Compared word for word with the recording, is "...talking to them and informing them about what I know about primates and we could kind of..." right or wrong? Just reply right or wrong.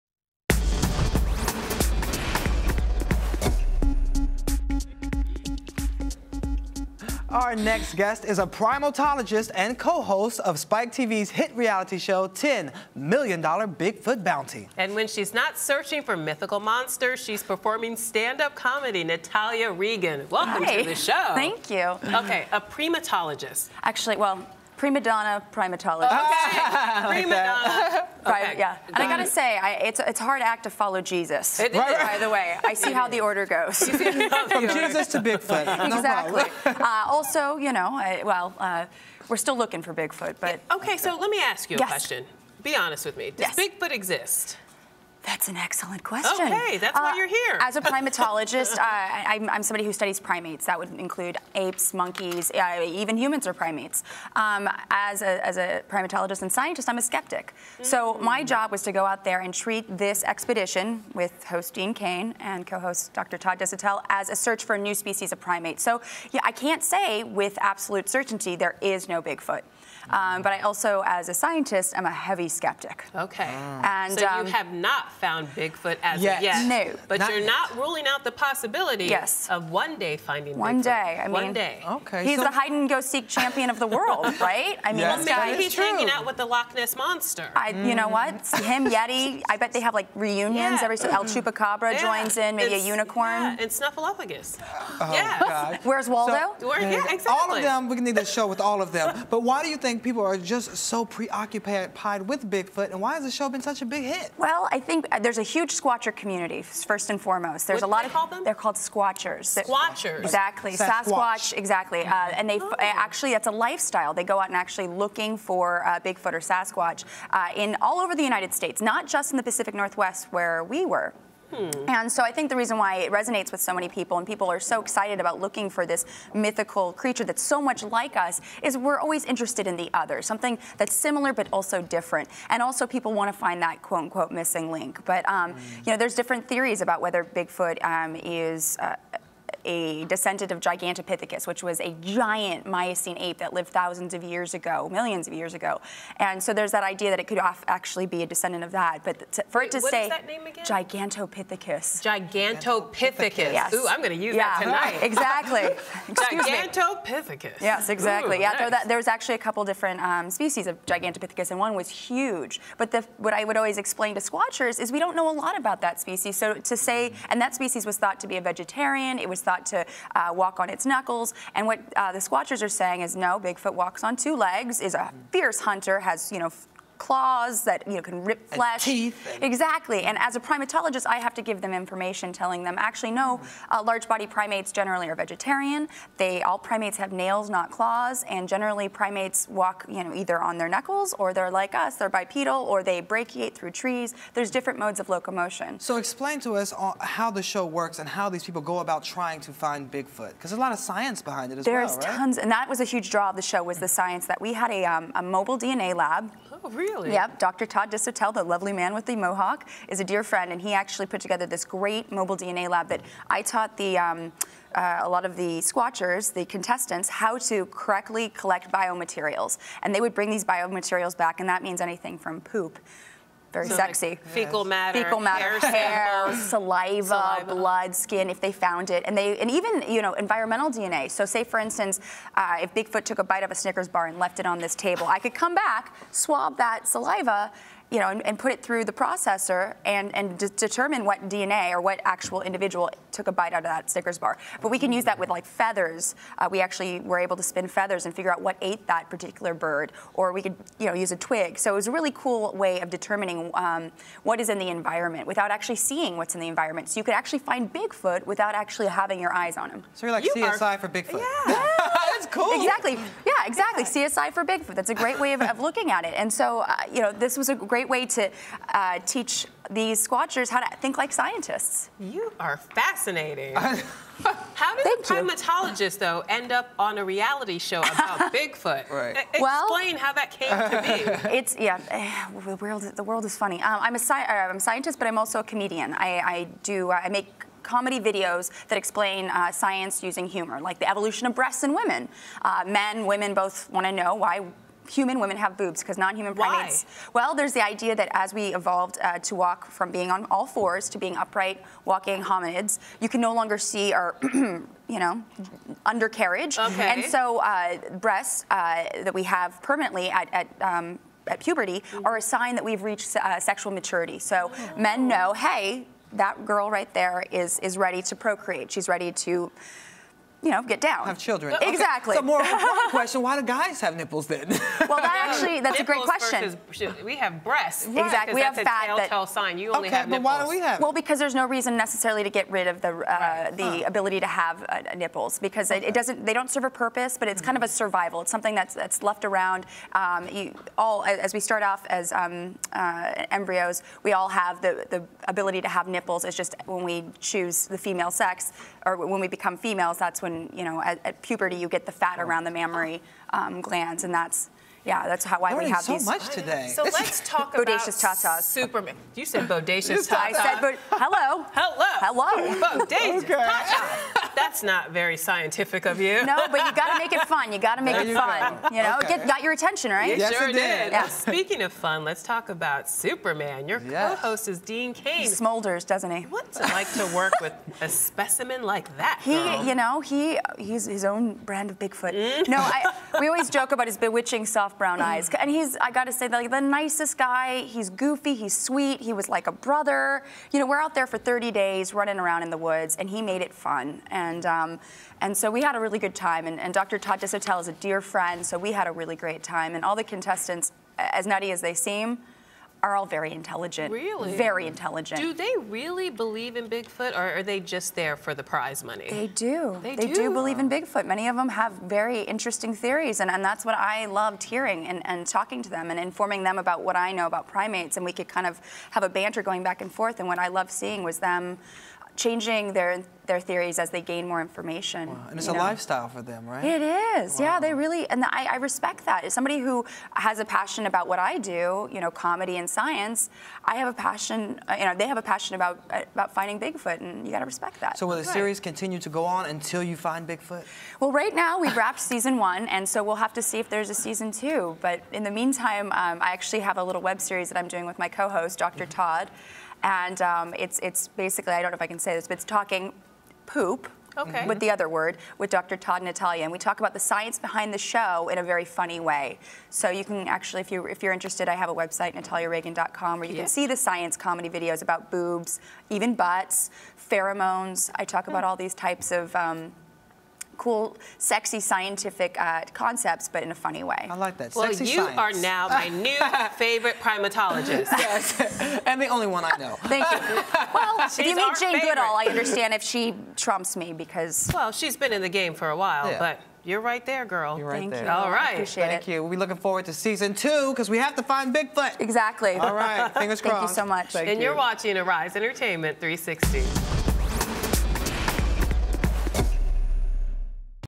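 right.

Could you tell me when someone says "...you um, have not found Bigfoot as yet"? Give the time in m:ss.
1:14.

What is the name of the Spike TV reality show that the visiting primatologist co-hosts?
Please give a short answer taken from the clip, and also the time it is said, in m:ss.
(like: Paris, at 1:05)
$10 Million Bigfoot Bounty, at 0:12.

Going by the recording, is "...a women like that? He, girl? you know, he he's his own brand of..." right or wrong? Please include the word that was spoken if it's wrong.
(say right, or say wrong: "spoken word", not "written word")
wrong: "specimen", not "women".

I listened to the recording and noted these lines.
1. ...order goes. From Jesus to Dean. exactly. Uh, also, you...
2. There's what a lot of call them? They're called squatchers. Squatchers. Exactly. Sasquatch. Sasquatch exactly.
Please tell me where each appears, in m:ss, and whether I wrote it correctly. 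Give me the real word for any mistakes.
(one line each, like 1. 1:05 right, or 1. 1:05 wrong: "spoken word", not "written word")
1. 0:33 wrong: "Bigfoot", not "Dean"
2. 1:47 right.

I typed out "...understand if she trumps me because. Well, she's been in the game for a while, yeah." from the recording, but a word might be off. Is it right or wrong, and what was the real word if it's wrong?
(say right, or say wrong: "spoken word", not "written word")
right.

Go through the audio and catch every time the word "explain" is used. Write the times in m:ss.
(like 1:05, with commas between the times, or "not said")
2:43, 3:15, 4:39, 4:48.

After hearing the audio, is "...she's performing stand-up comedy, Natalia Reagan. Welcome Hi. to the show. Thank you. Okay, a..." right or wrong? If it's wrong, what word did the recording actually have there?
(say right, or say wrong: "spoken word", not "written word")
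right.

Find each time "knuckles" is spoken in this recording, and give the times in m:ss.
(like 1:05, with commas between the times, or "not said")
2:50, 3:10.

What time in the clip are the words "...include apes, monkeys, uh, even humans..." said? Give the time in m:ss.
0:50.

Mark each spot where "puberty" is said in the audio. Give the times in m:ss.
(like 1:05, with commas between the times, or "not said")
5:11, 5:51.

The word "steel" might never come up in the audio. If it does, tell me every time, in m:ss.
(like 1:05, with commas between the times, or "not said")
not said.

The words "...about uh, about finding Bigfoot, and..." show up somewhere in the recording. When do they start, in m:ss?
7:15.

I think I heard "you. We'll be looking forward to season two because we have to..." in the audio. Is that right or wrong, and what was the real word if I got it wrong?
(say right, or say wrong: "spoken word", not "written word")
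right.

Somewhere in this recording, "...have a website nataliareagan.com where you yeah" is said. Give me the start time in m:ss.
7:41.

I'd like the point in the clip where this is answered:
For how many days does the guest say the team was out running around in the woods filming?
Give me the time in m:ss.
6:31.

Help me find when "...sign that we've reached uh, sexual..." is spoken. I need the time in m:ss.
5:12.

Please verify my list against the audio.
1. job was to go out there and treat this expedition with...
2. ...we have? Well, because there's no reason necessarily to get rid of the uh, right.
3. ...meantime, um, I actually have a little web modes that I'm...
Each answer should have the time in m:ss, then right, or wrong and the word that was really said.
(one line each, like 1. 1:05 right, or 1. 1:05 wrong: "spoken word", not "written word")
1. 0:58 right
2. 5:30 right
3. 7:25 wrong: "series", not "modes".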